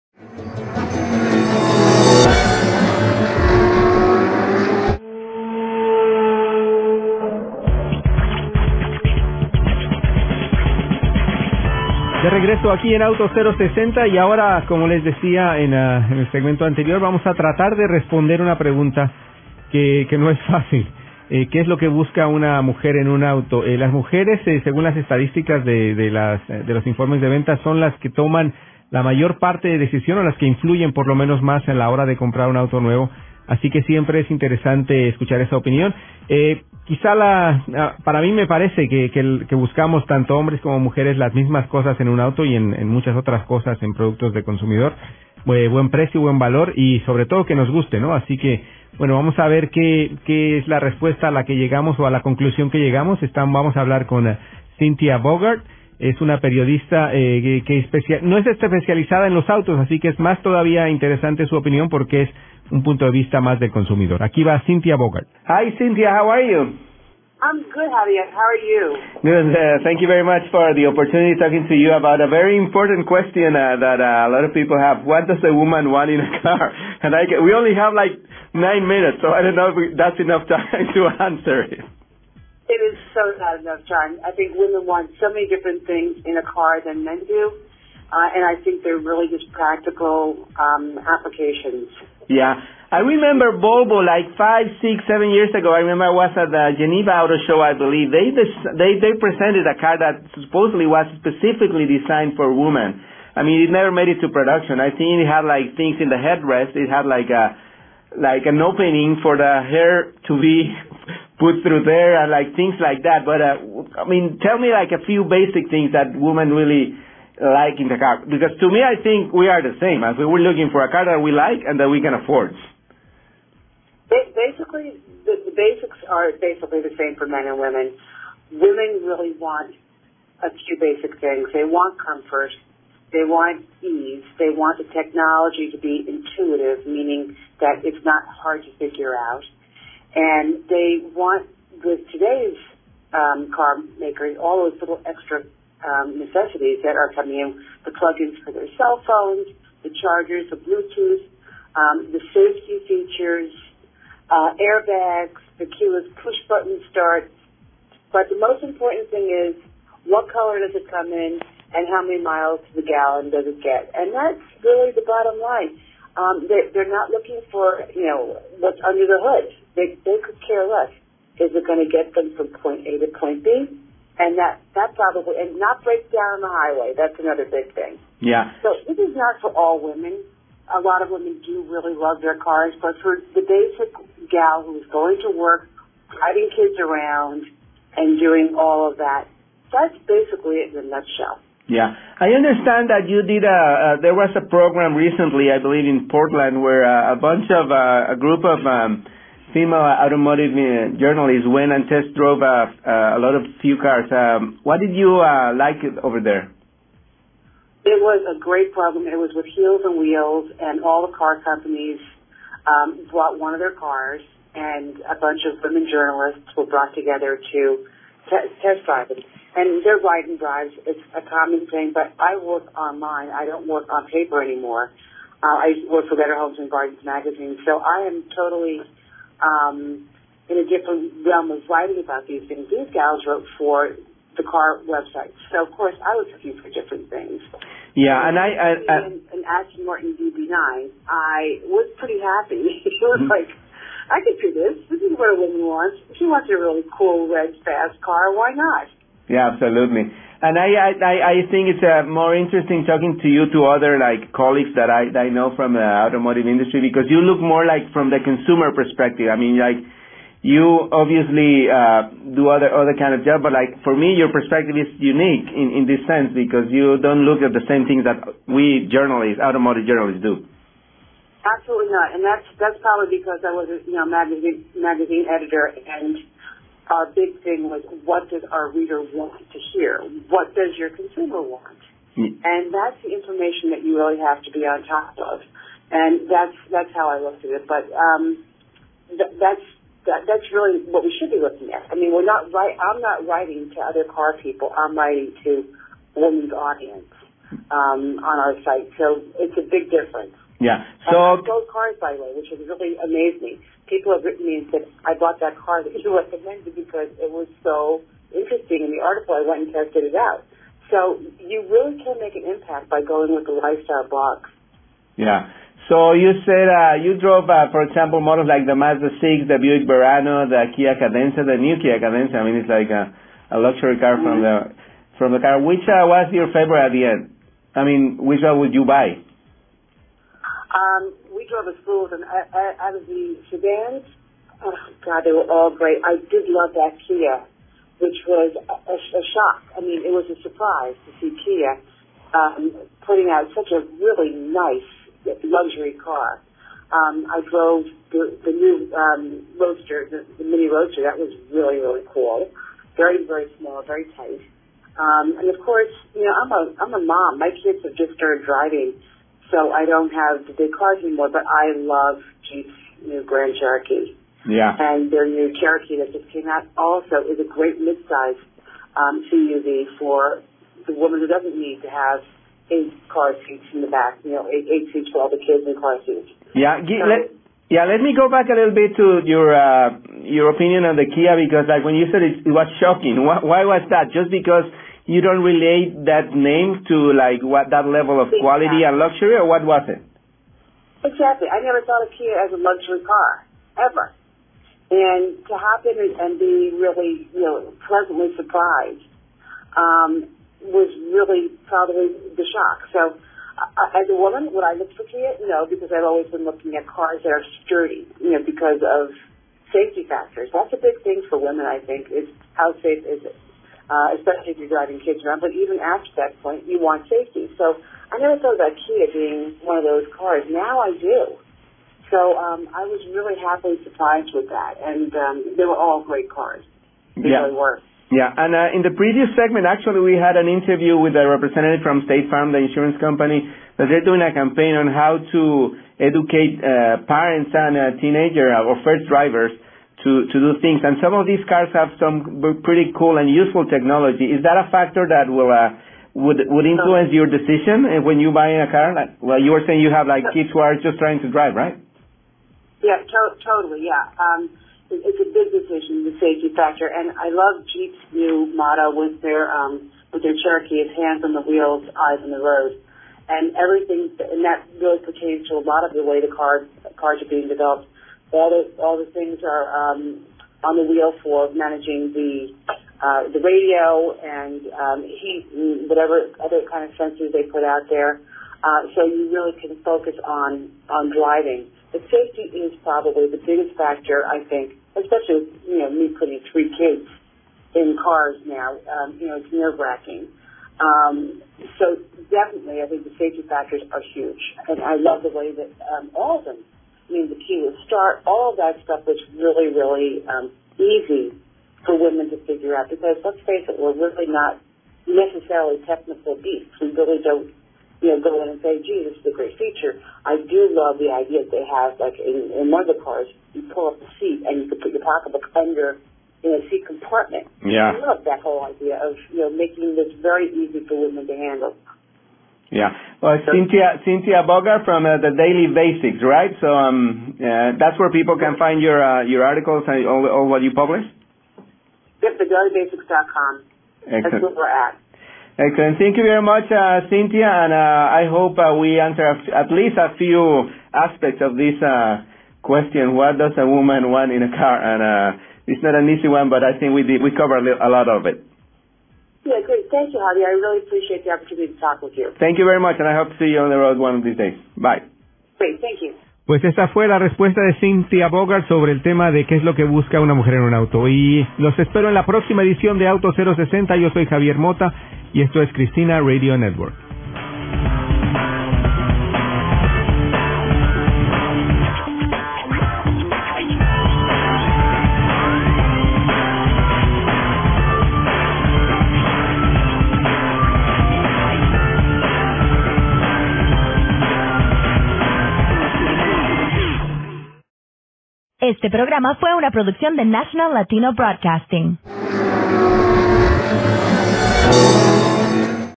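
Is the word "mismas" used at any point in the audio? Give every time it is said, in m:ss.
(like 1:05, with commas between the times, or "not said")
0:41.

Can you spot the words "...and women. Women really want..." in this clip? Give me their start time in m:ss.
2:07.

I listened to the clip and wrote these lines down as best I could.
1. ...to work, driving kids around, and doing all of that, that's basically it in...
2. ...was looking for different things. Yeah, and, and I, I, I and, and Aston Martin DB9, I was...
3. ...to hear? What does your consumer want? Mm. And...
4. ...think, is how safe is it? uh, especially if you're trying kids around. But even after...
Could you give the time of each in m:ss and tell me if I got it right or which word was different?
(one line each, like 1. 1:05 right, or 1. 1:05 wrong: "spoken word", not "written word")
1. 3:05 right
2. 3:56 right
3. 4:39 right
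4. 6:51 wrong: "driving", not "trying".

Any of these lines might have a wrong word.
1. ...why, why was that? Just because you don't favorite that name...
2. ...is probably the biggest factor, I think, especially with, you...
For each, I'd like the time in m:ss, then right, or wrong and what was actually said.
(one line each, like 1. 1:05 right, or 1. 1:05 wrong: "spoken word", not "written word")
1. 6:23 wrong: "relate", not "favorite"
2. 8:02 right.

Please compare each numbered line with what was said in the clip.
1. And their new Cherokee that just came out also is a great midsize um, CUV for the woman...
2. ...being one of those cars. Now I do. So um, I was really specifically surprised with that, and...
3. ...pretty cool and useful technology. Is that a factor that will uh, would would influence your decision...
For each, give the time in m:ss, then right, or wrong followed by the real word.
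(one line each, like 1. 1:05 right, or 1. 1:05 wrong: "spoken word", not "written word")
1. 6:04 right
2. 6:59 wrong: "happily", not "specifically"
3. 7:22 right.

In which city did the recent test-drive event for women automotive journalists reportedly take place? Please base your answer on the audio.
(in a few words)
Portland.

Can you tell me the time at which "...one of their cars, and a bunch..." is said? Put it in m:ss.
3:33.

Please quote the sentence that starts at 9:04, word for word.
And it's not an easy one, but I think we did, we covered a lot of it.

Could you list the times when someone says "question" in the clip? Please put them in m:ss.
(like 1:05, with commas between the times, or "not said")
1:13, 9:02.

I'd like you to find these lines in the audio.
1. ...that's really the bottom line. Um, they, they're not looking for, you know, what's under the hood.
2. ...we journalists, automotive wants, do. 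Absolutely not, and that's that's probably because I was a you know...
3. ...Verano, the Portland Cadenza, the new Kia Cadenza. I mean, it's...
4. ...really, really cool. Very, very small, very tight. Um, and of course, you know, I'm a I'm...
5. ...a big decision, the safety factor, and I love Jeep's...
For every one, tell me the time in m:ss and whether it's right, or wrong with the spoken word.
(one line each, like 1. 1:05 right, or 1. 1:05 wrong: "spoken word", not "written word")
1. 2:44 right
2. 4:28 wrong: "journalists", not "wants"
3. 5:19 wrong: "Kia", not "Portland"
4. 5:51 right
5. 7:35 right.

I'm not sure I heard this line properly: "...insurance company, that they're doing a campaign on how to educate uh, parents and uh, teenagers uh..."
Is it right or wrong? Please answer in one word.
right.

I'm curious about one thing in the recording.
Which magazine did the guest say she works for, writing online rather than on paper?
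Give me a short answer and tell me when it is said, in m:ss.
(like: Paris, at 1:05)
Better Homes and Gardens, at 3:46.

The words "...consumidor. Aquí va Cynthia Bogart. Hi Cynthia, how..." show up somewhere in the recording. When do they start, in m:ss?
1:03.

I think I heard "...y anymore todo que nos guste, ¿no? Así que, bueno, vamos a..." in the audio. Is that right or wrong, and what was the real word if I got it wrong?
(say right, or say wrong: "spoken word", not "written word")
wrong: "sobre", not "anymore".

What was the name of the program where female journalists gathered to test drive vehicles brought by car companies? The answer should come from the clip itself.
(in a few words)
Heels and Wheels.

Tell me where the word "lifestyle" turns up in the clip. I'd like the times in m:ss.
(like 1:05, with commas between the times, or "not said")
5:13.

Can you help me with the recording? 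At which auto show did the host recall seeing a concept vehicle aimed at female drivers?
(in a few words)
Geneva Auto Show.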